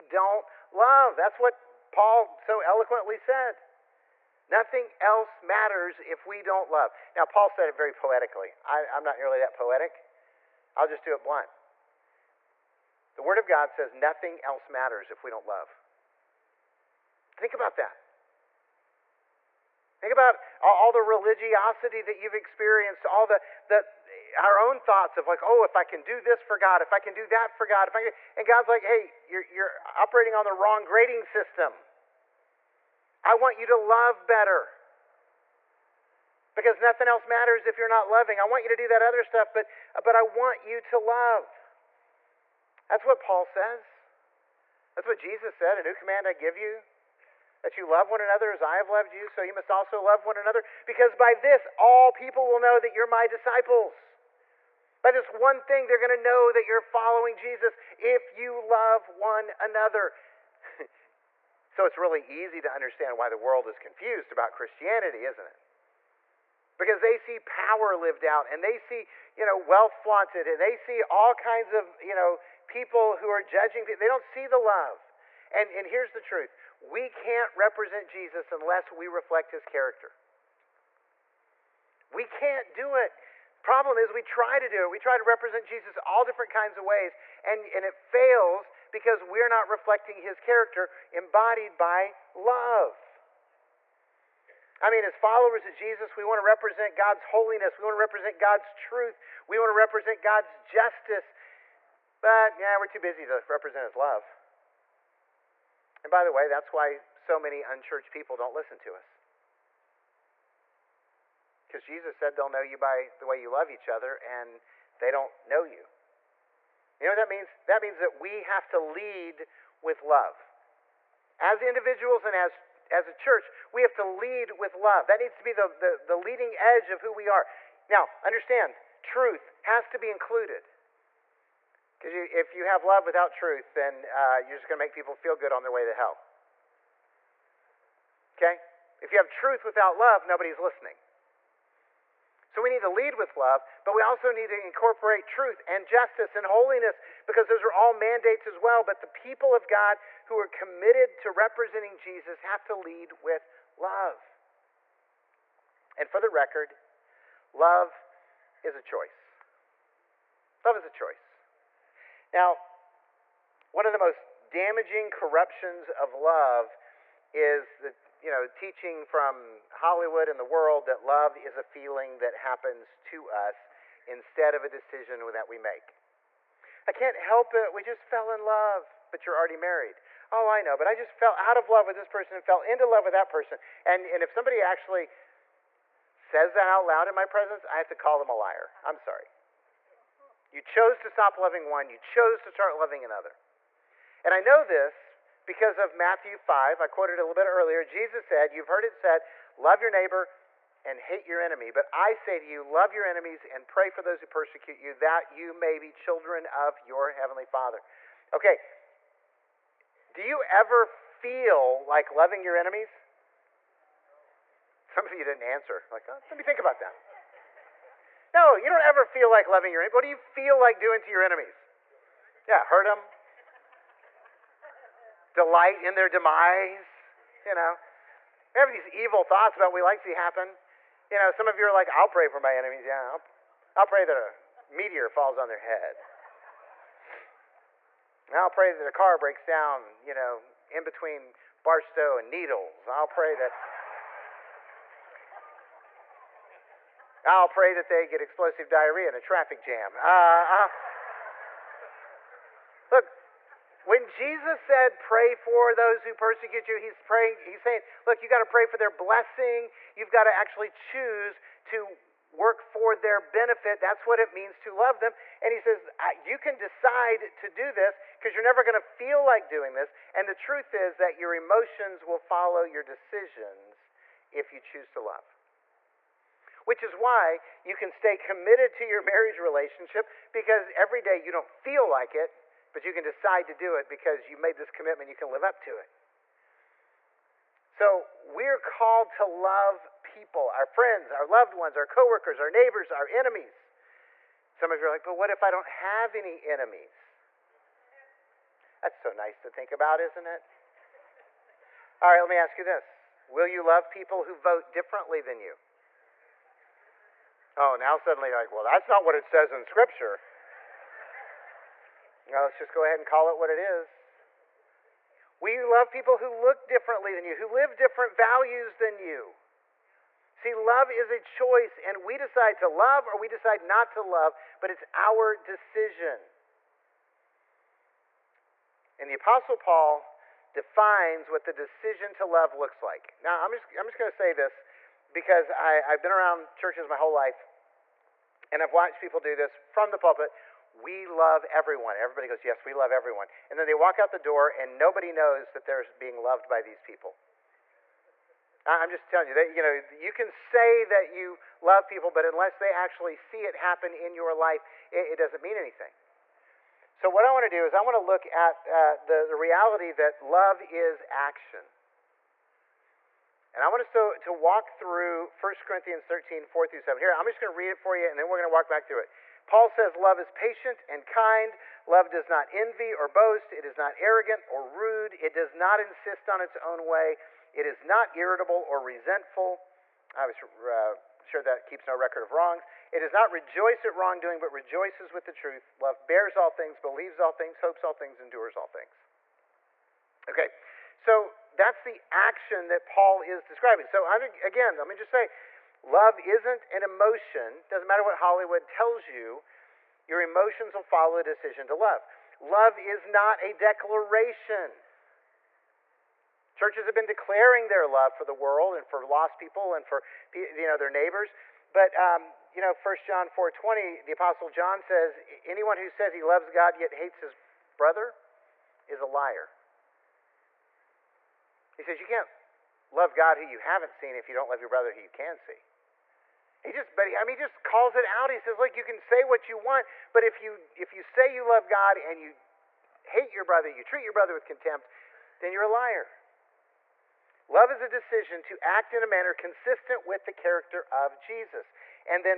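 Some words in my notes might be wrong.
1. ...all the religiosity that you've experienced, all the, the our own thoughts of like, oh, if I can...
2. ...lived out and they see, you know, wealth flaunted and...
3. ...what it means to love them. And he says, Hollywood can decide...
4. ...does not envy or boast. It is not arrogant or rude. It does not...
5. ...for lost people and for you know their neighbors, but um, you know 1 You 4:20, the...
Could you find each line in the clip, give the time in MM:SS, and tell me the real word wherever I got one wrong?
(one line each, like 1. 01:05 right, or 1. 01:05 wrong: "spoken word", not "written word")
1. 00:20 right
2. 01:07 right
3. 04:24 wrong: "You", not "Hollywood"
4. 06:12 right
5. 06:48 wrong: "John", not "You".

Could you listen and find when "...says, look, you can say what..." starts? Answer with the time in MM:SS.
07:08.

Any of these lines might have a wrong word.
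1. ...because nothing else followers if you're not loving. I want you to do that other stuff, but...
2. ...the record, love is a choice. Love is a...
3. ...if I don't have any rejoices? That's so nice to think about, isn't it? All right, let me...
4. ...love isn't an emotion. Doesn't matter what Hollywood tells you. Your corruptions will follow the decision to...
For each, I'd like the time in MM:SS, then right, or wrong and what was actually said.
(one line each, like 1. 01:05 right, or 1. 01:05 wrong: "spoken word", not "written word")
1. 00:36 wrong: "matters", not "followers"
2. 02:36 right
3. 04:55 wrong: "enemies", not "rejoices"
4. 06:35 wrong: "emotions", not "corruptions".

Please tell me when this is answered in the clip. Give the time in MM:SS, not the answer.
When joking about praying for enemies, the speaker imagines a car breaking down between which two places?
04:01.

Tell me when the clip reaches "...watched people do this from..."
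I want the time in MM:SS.
05:38.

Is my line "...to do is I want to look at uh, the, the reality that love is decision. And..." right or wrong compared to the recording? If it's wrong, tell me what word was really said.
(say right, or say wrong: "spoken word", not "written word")
wrong: "action", not "decision".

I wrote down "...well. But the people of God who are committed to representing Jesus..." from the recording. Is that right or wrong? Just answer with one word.
right.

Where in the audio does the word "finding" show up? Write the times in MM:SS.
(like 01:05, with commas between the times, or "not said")
not said.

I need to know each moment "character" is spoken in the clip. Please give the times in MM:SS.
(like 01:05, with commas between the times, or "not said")
01:19, 01:30, 07:20.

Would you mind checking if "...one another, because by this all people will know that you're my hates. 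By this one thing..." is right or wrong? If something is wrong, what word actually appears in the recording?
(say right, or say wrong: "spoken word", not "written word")
wrong: "disciples", not "hates".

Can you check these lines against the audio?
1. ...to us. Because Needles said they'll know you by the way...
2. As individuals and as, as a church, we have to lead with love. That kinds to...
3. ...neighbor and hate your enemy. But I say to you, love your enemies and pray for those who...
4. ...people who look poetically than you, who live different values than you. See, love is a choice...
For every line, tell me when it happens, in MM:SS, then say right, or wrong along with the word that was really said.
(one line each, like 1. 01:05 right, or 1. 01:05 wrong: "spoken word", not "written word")
1. 01:48 wrong: "Jesus", not "Needles"
2. 02:01 wrong: "needs", not "kinds"
3. 03:19 right
4. 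05:15 wrong: "differently", not "poetically".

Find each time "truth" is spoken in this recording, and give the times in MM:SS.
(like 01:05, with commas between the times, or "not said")
01:16, 01:38, 02:09, 02:13, 02:19, 02:25, 04:30, 06:25.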